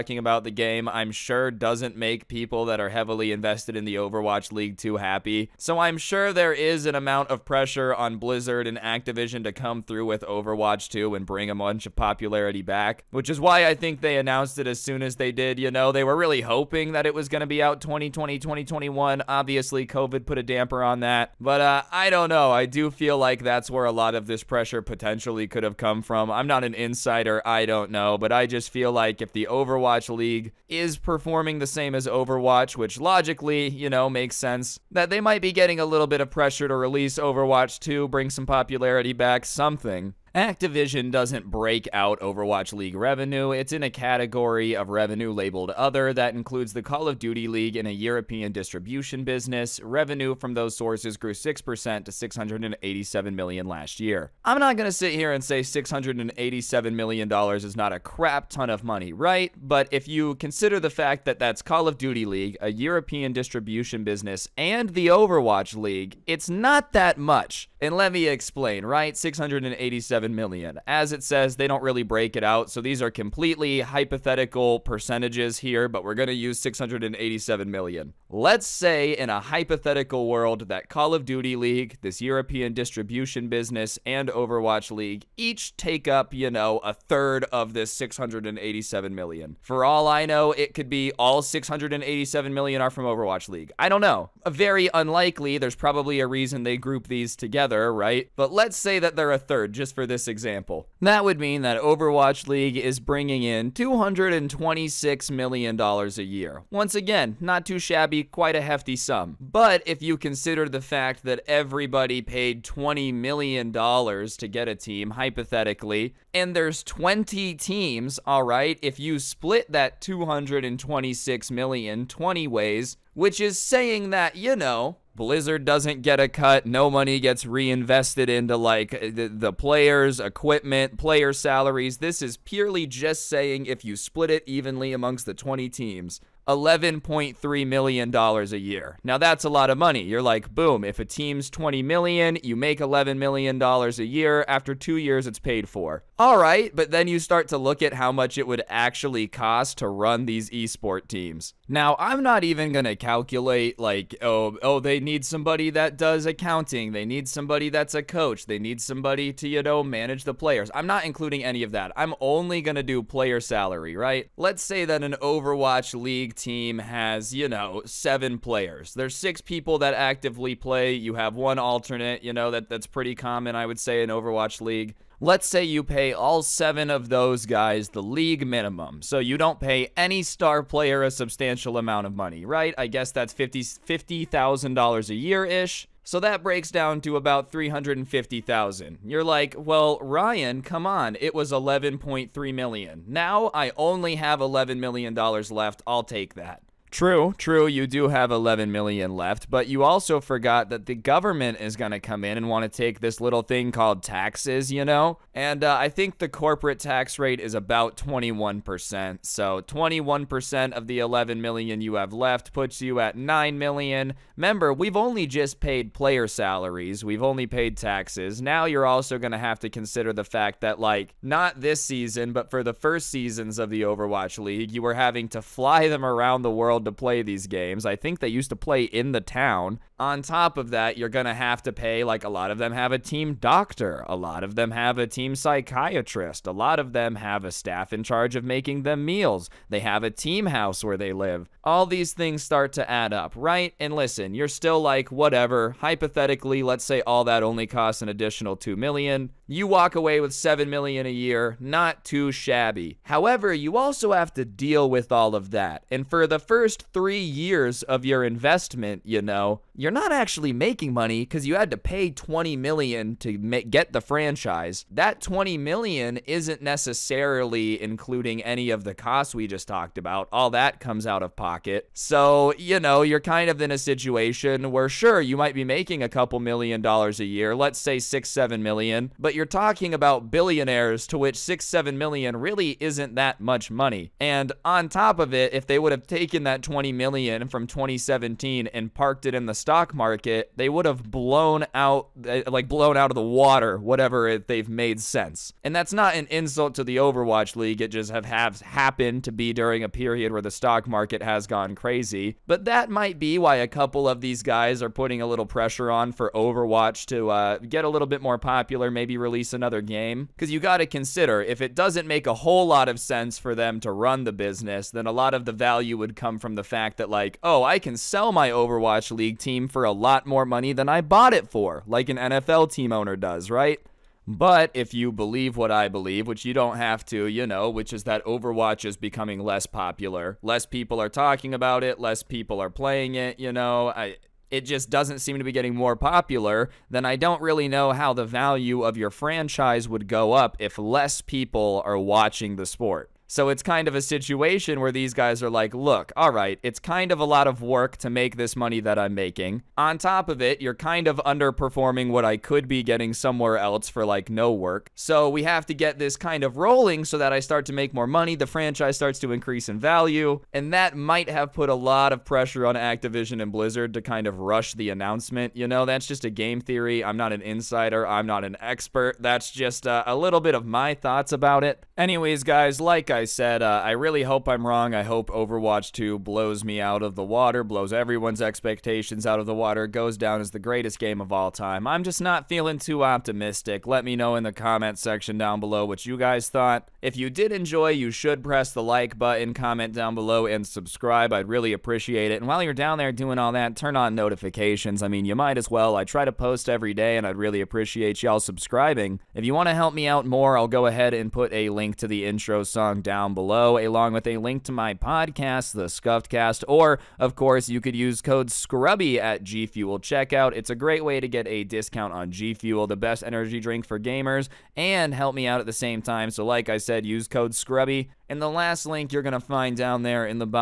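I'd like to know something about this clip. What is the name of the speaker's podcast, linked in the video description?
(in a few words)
The Scuffed Cast.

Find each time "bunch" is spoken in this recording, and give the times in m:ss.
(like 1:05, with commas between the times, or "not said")
0:11.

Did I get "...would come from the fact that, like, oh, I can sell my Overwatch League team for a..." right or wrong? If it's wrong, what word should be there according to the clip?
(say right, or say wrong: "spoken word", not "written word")
right.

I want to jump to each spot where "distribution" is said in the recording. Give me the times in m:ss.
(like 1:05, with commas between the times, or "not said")
0:48, 1:03, 1:22.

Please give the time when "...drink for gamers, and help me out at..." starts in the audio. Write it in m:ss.
6:53.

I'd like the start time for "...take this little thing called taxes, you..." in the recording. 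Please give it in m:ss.
3:22.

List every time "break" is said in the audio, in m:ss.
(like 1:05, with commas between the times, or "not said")
0:41, 1:12, 3:06.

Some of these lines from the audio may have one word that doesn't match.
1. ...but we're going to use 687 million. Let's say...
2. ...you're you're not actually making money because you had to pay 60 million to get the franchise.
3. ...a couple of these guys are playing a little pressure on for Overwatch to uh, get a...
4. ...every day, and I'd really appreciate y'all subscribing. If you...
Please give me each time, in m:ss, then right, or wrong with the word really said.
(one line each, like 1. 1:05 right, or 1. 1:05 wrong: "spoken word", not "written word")
1. 1:15 right
2. 4:19 wrong: "20", not "60"
3. 5:03 wrong: "putting", not "playing"
4. 6:36 right.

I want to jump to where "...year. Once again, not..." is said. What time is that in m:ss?
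1:46.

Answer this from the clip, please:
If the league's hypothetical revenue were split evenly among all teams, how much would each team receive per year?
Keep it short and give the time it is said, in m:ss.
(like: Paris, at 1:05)
$11.3 million, at 2:16.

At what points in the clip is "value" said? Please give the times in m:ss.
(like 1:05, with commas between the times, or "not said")
5:15, 5:38, 5:59.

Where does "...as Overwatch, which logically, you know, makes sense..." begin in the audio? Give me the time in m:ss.
0:31.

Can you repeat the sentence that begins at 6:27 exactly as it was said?
If you did enjoy, you should press the like button, comment down below, and subscribe.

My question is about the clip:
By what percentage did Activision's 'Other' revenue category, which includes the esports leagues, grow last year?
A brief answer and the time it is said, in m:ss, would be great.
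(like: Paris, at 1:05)
6%, at 0:51.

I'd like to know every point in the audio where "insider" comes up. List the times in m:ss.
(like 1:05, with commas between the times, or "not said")
0:26, 6:07.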